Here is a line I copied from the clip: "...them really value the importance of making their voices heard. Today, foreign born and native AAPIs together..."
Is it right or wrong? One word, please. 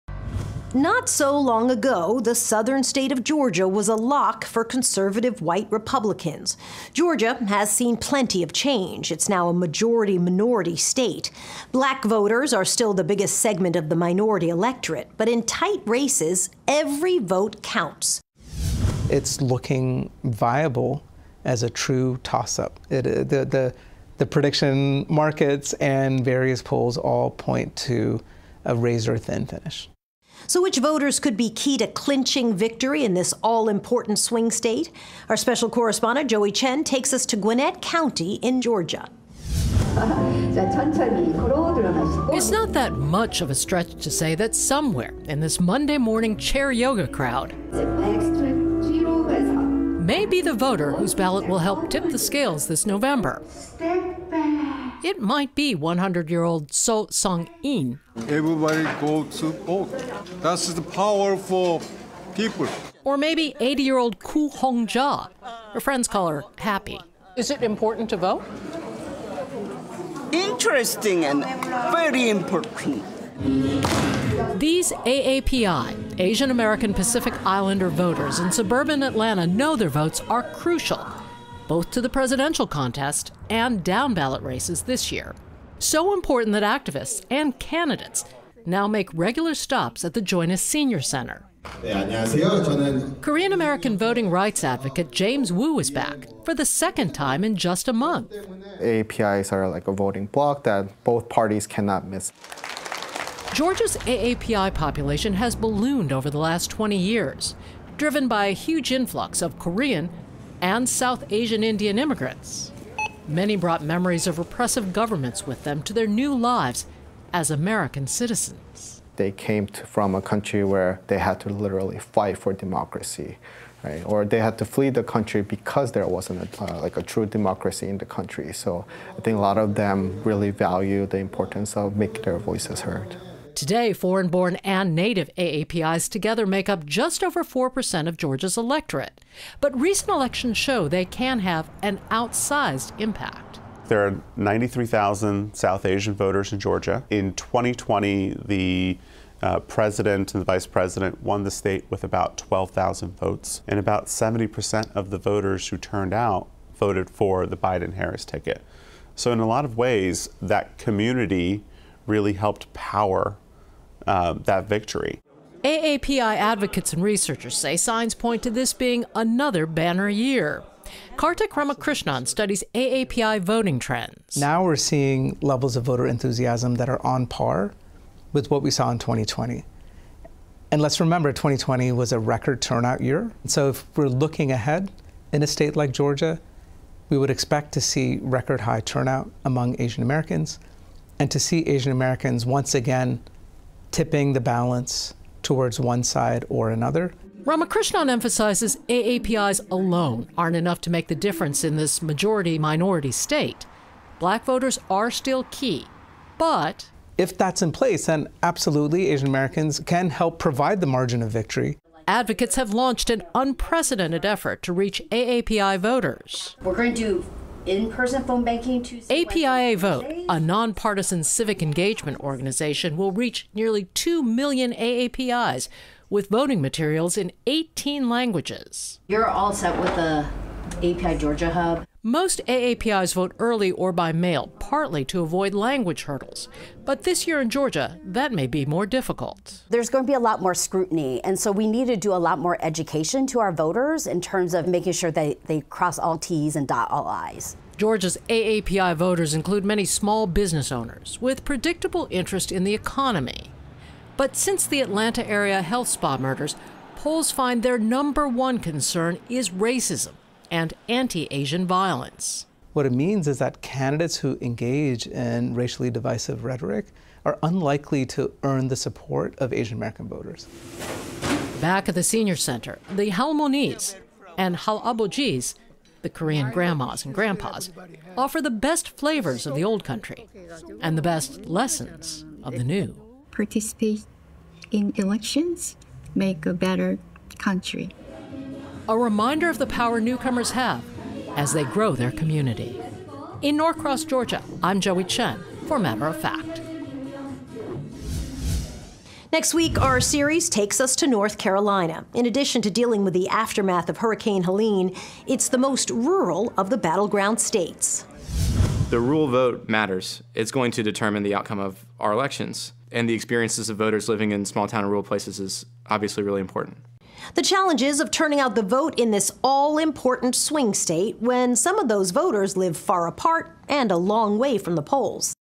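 right.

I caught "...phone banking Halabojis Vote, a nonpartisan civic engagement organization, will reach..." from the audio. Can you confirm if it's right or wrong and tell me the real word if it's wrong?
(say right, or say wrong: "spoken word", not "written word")
wrong: "APIA", not "Halabojis".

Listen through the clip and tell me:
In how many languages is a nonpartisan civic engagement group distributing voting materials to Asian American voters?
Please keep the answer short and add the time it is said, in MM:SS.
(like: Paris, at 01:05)
18, at 03:47.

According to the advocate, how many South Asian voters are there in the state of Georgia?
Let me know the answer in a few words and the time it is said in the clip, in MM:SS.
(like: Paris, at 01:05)
93,000, at 02:24.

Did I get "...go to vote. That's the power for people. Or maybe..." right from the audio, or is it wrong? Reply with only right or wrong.
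right.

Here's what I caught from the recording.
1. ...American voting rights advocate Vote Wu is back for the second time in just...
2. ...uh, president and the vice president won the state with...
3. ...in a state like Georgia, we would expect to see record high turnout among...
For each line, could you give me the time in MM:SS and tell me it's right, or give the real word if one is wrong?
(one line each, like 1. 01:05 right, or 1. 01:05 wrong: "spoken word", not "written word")
1. 01:33 wrong: "James", not "Vote"
2. 02:29 right
3. 03:05 right.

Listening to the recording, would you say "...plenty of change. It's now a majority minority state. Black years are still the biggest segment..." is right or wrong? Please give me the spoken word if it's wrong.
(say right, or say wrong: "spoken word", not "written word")
wrong: "voters", not "years".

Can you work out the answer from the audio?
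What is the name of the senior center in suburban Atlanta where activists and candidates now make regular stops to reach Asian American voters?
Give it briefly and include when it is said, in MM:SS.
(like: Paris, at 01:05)
Join Us Senior Center, at 01:30.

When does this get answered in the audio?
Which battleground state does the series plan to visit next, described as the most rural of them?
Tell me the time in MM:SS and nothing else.
05:01.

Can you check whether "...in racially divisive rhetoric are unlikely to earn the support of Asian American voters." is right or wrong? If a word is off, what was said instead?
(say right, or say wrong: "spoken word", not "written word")
right.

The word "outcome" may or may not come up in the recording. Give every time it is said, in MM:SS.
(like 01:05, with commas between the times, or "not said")
05:11.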